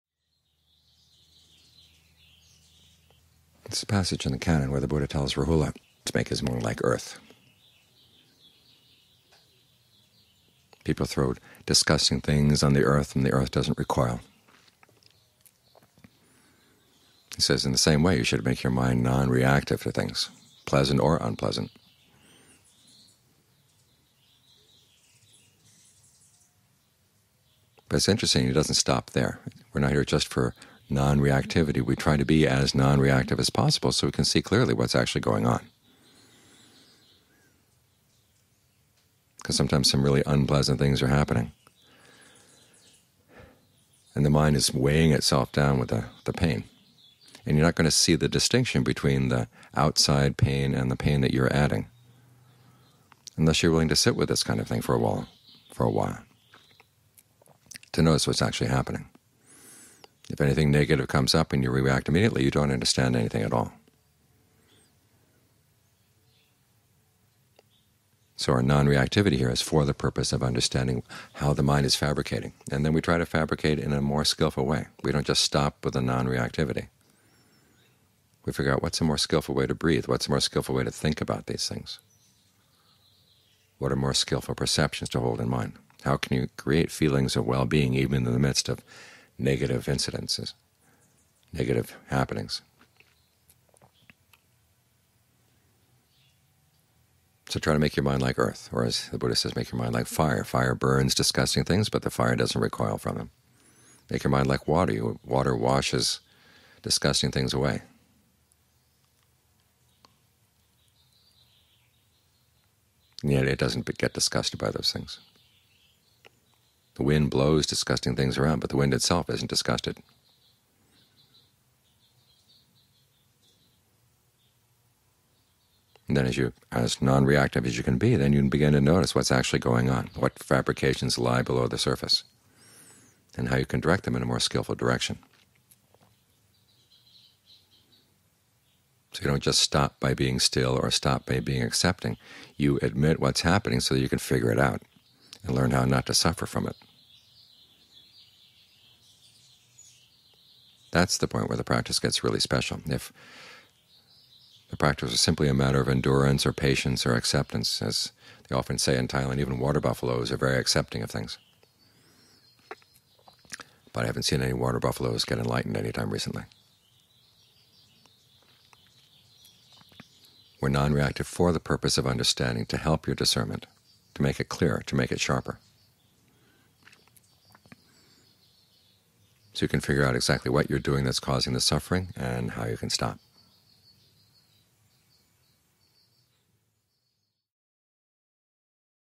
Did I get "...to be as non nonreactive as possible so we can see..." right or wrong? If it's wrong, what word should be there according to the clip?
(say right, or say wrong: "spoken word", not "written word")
wrong: "reactive", not "nonreactive".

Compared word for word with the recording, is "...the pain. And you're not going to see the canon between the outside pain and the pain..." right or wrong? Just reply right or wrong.
wrong.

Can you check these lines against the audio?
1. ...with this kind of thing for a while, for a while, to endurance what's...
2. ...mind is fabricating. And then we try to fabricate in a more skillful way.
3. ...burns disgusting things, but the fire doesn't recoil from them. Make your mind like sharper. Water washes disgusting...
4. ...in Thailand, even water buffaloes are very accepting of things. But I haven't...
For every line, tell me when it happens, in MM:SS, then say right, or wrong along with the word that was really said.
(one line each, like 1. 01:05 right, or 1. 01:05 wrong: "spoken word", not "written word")
1. 00:54 wrong: "notice", not "endurance"
2. 01:11 right
3. 01:40 wrong: "water", not "sharper"
4. 02:38 right.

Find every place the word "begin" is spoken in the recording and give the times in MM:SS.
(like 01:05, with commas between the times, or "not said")
02:08.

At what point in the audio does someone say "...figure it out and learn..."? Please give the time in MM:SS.
02:24.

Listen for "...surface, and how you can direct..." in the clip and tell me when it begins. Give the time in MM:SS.
02:11.